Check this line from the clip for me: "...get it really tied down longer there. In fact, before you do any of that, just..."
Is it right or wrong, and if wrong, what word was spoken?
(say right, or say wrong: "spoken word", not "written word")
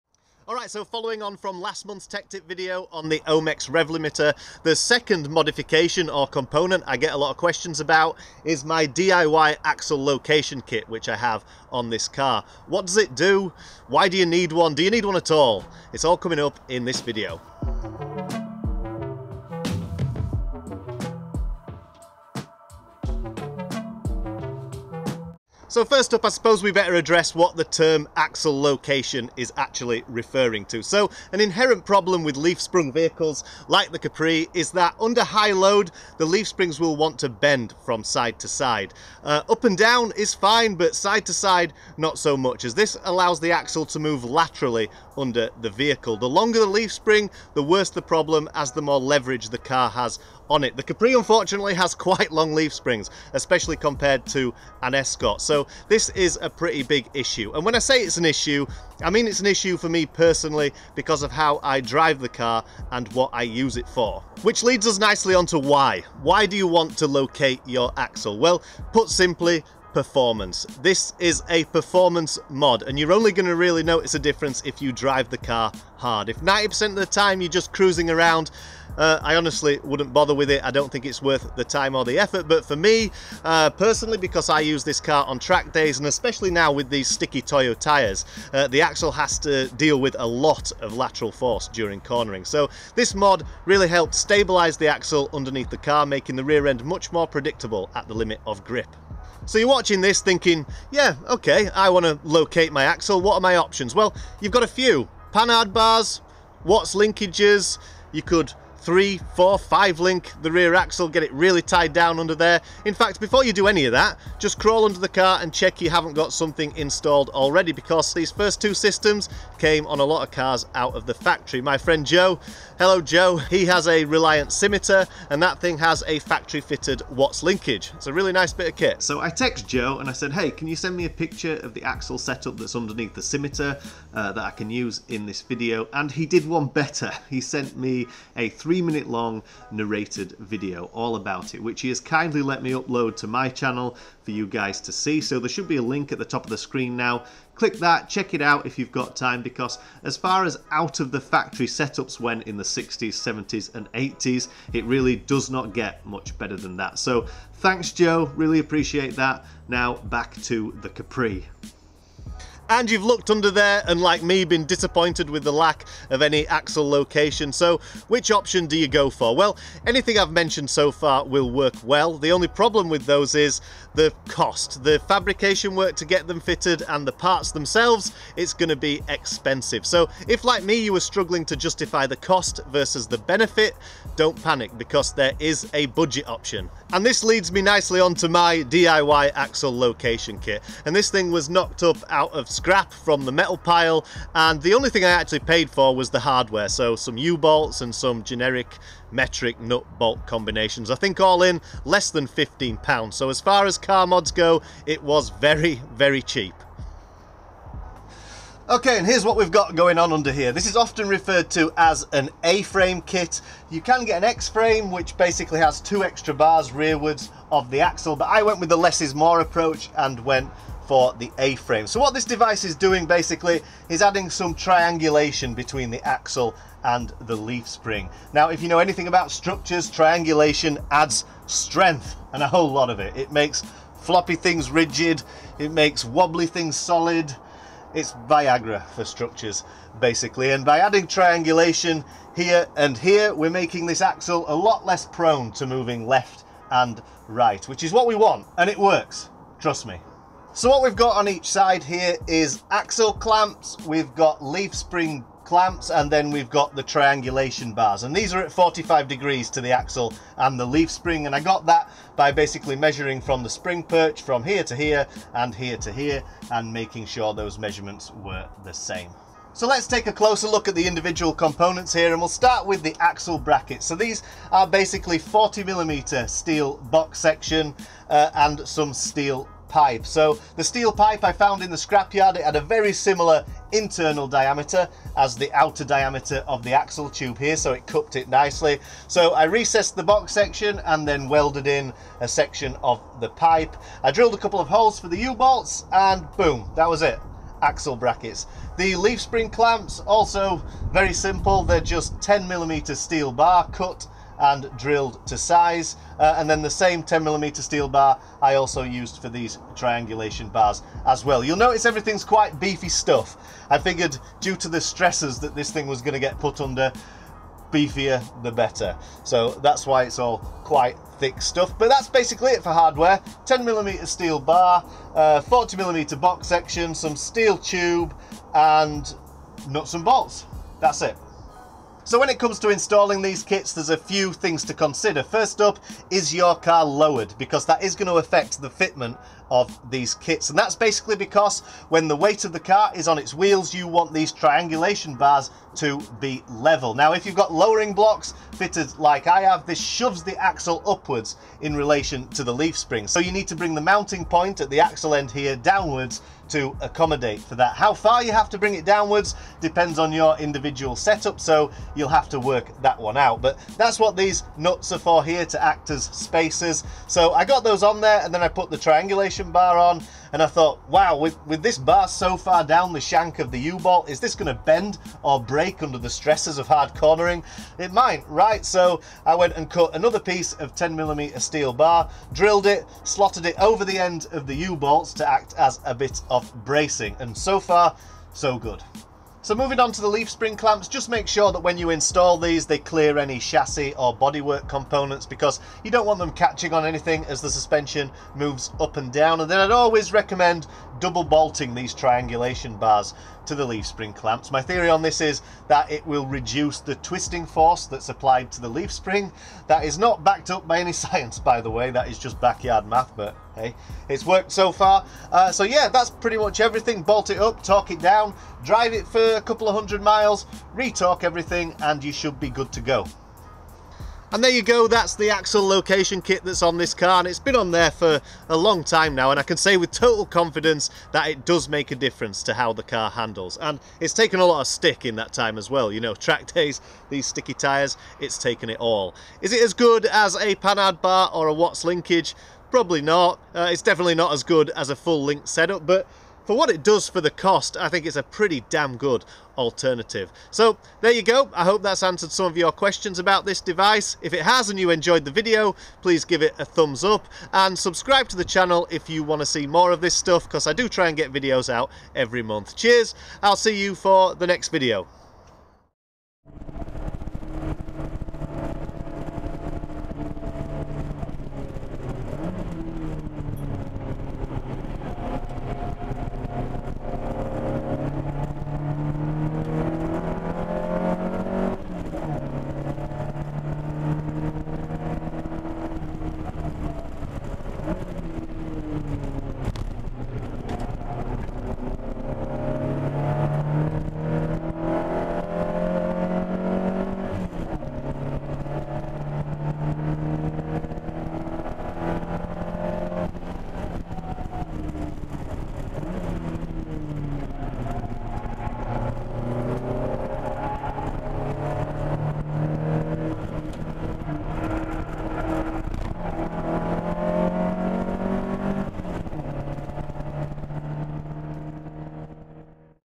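wrong: "under", not "longer".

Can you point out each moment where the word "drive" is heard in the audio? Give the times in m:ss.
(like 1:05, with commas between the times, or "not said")
1:01, 1:14, 6:58.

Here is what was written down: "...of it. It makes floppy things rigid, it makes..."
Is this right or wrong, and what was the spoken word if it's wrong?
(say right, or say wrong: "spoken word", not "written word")
right.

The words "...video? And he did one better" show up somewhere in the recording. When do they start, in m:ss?
2:15.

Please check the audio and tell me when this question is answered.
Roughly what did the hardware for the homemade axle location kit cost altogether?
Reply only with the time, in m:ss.
3:21.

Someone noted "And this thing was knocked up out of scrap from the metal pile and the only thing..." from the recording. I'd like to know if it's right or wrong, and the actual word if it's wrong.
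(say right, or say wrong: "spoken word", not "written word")
right.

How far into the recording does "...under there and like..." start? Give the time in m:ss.
2:43.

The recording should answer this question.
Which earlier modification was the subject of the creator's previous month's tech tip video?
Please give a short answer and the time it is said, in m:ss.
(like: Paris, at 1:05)
Omex rev limiter, at 0:03.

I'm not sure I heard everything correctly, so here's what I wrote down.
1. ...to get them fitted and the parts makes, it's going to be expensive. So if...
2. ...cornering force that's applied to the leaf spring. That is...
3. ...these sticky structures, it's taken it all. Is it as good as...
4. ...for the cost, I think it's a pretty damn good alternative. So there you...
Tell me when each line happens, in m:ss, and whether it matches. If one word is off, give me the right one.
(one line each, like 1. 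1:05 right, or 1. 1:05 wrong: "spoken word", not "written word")
1. 2:55 wrong: "themselves", not "makes"
2. 6:46 wrong: "twisting", not "cornering"
3. 7:17 wrong: "tyres", not "structures"
4. 7:27 right.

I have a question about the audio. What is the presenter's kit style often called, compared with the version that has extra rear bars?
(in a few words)
A-frame kit.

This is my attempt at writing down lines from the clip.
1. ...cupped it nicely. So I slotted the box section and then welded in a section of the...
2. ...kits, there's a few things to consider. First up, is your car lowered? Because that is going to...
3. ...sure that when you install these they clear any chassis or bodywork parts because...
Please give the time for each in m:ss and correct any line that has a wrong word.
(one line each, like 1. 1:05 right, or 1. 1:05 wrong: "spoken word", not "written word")
1. 4:47 wrong: "recessed", not "slotted"
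2. 5:33 right
3. 6:31 wrong: "components", not "parts".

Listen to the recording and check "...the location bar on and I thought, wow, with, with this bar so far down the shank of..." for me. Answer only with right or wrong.
wrong.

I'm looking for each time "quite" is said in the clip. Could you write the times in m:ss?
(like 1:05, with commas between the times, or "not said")
0:51, 5:12, 5:20.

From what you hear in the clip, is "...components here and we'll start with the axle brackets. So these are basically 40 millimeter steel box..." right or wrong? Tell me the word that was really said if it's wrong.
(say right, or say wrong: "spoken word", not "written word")
right.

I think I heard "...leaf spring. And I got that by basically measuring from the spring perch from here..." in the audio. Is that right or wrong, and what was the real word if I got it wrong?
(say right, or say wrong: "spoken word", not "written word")
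right.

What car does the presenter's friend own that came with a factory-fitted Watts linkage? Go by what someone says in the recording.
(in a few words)
Reliant Scimitar.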